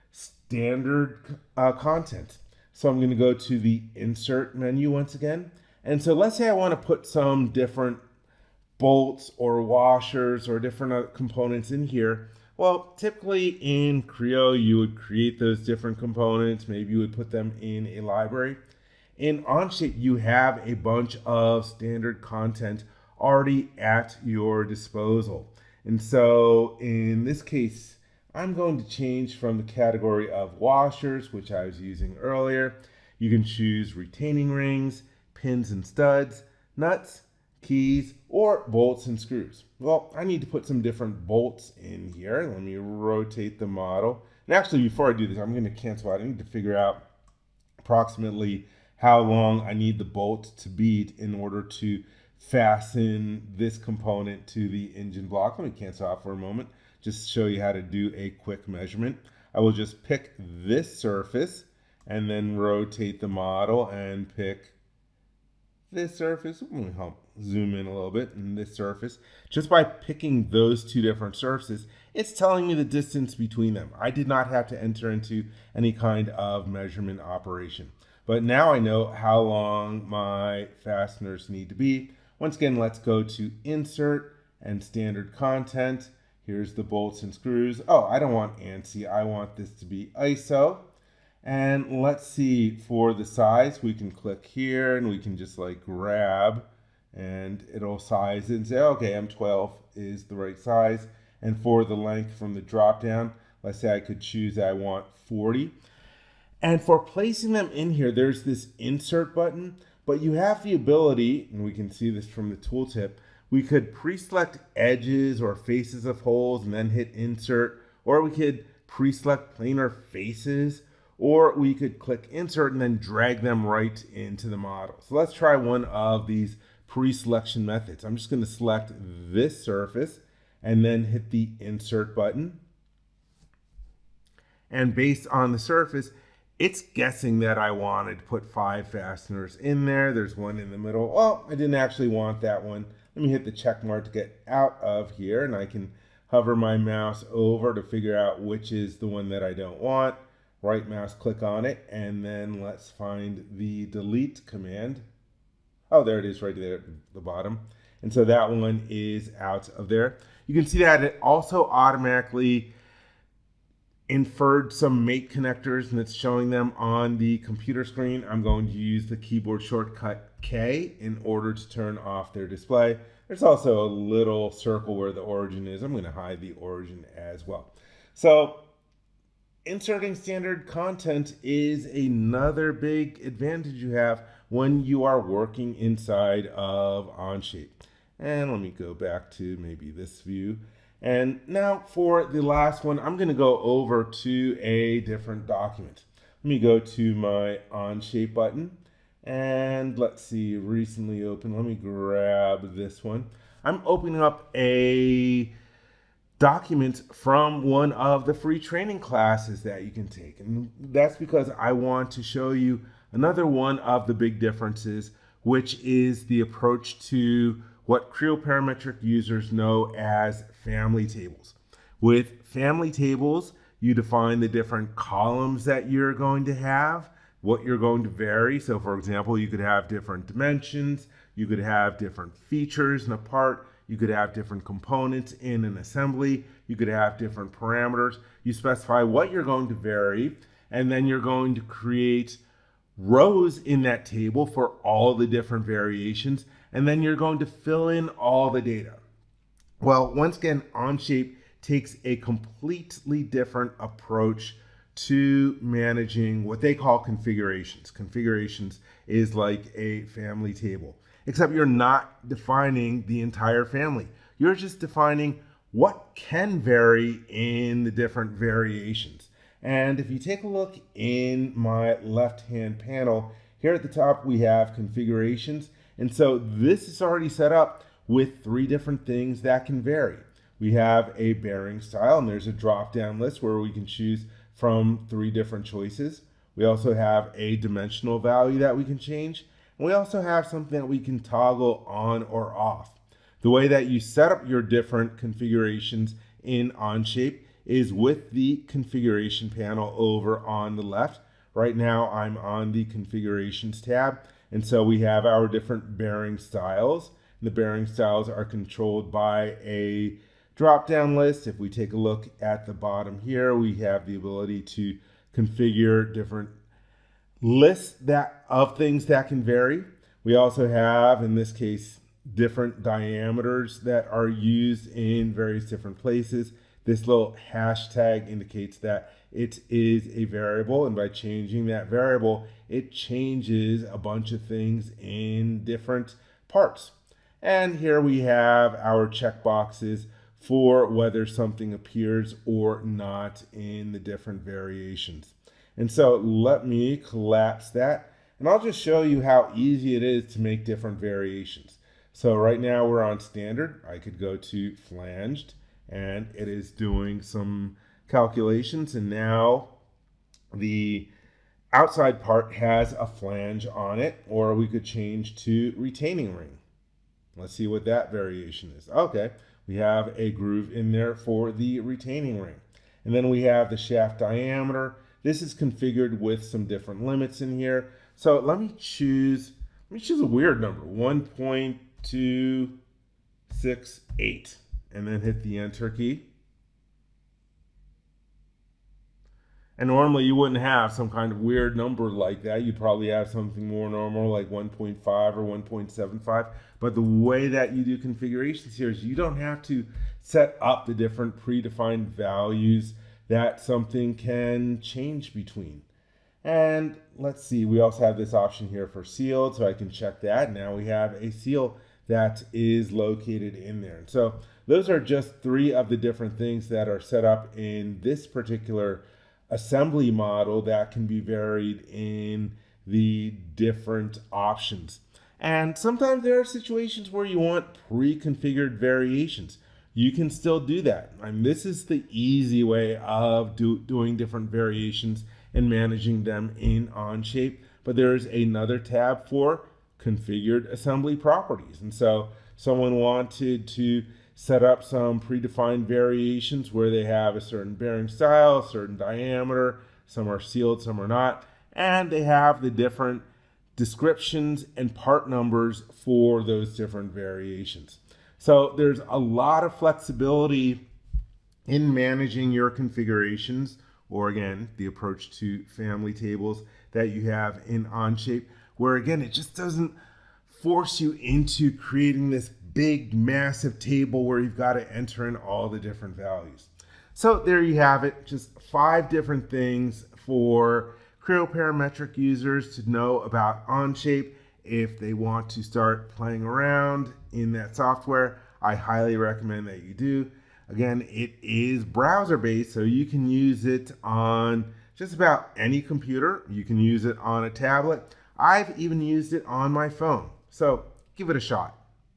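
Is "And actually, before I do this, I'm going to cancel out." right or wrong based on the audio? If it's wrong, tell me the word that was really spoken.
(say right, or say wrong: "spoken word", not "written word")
right.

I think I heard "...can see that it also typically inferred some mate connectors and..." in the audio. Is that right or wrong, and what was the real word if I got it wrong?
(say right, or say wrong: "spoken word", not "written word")
wrong: "automatically", not "typically".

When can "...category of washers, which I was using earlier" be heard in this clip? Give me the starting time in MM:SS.
00:29.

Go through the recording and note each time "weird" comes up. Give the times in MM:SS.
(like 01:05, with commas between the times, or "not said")
06:20, 06:31.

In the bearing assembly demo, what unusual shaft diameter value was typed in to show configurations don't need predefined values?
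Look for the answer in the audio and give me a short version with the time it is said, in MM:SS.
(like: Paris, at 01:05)
1.268, at 06:20.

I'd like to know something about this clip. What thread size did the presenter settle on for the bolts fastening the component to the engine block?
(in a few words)
M12.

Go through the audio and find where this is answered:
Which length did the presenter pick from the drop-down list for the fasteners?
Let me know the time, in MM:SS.
01:45.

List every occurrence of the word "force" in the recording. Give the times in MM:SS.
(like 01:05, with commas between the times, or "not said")
07:50.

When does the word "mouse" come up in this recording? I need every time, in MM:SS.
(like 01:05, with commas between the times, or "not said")
02:26, 02:30.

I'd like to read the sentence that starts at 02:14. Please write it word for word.
And based on the surface, it's guessing that I wanted to put five fasteners in there.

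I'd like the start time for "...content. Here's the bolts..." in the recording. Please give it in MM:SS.
01:25.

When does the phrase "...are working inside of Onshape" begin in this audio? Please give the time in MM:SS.
03:05.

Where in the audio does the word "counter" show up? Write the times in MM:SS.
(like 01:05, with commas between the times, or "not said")
not said.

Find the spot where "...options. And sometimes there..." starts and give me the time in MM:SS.
07:04.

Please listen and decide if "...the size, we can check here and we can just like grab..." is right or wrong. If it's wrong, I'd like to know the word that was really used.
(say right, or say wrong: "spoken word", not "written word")
wrong: "click", not "check".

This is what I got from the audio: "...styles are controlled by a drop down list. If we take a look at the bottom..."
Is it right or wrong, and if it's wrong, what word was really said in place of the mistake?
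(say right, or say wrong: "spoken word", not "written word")
right.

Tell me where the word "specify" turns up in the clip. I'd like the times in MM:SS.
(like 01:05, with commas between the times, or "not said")
03:58.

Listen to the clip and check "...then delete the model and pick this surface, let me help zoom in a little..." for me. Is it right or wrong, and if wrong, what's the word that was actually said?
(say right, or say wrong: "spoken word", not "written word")
wrong: "rotate", not "delete".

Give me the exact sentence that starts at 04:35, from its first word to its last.
And so this is already set up with three different things that can vary.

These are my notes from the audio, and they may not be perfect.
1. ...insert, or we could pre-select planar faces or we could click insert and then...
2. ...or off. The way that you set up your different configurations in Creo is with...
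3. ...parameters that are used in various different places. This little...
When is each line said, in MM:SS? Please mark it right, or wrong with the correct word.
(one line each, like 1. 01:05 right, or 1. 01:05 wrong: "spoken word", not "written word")
1. 01:57 right
2. 04:52 wrong: "Onshape", not "Creo"
3. 05:22 wrong: "diameters", not "parameters".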